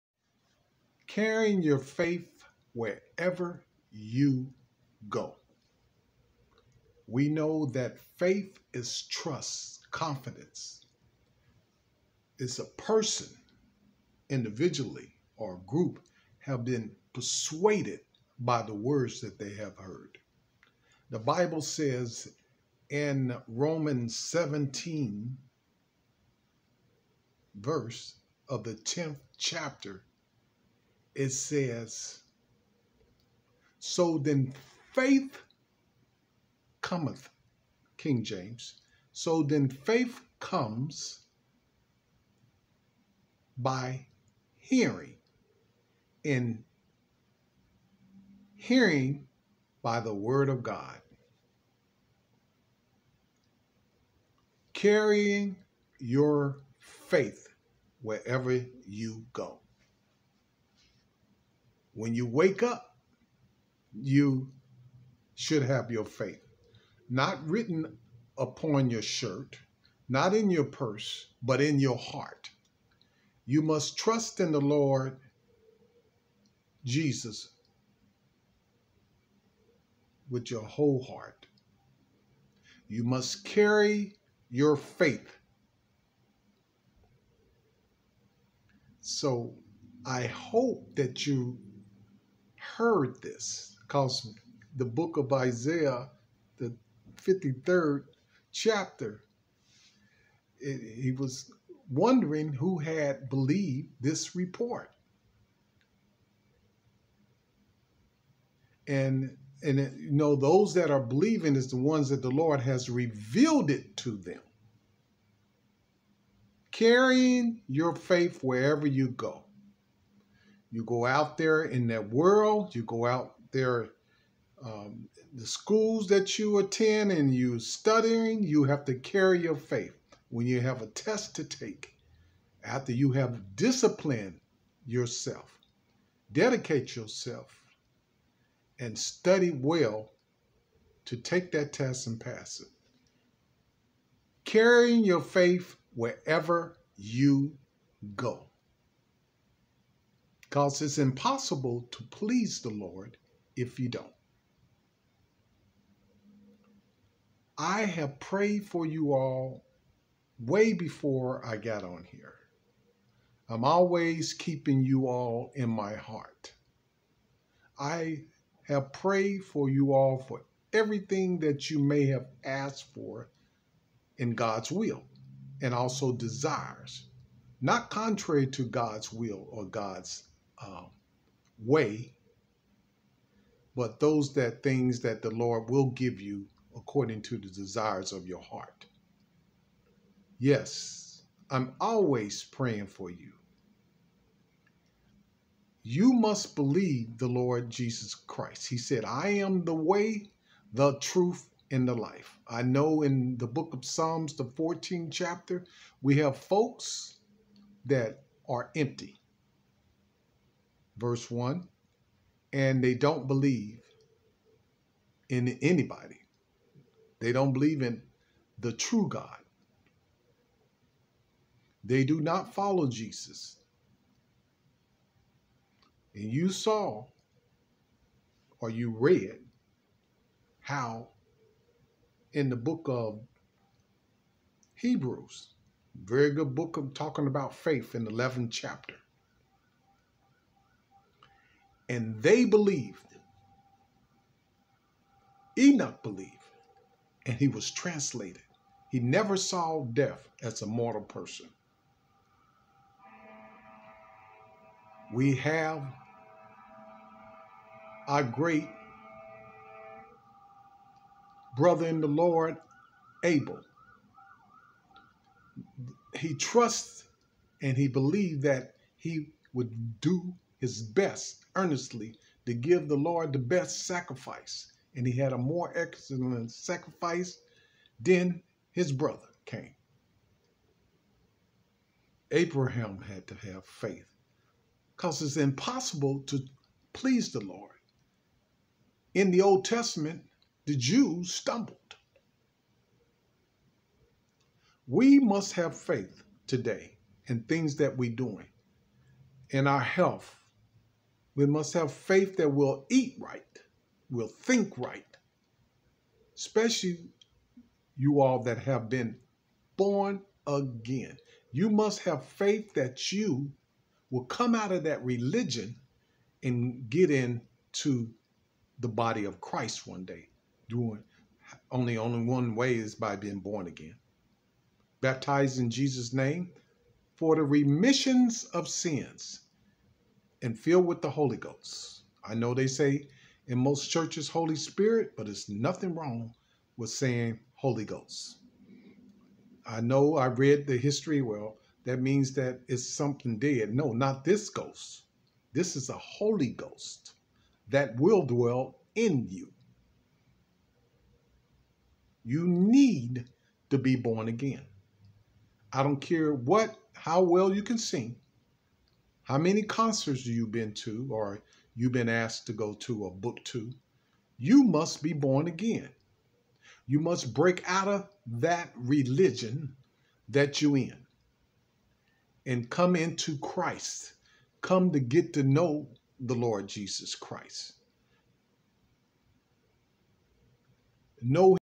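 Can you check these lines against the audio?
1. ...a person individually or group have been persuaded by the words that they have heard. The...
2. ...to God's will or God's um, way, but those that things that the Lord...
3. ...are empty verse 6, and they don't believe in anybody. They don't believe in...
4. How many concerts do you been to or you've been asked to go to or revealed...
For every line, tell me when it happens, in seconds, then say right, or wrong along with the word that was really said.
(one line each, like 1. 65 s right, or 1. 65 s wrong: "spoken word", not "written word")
1. 12 s right
2. 178 s right
3. 208 s wrong: "1", not "6"
4. 359 s wrong: "booked", not "revealed".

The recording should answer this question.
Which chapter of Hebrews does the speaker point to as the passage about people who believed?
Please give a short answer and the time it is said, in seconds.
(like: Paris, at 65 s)
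11th chapter, at 238 s.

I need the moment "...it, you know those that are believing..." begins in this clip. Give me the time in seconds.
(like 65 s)
109 s.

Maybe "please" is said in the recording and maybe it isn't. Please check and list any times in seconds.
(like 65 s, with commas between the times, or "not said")
152 s, 286 s.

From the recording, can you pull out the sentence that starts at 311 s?
You must have faith that you will come out of that religion and get into the body of Christ one day.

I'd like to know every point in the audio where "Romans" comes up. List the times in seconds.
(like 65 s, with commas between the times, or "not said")
23 s.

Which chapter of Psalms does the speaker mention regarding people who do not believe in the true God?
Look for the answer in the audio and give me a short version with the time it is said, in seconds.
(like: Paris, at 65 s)
14th chapter, at 204 s.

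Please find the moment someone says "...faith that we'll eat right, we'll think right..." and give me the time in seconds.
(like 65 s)
301 s.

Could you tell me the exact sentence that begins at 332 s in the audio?
I know they say in most churches Holy Spirit, but it's nothing wrong with saying Holy Ghost.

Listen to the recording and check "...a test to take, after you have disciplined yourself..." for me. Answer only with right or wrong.
right.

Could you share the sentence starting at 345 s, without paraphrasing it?
This is a Holy Ghost that will dwell in you.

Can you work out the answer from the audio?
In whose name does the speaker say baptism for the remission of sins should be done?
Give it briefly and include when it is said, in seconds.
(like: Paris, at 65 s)
Jesus' name, at 325 s.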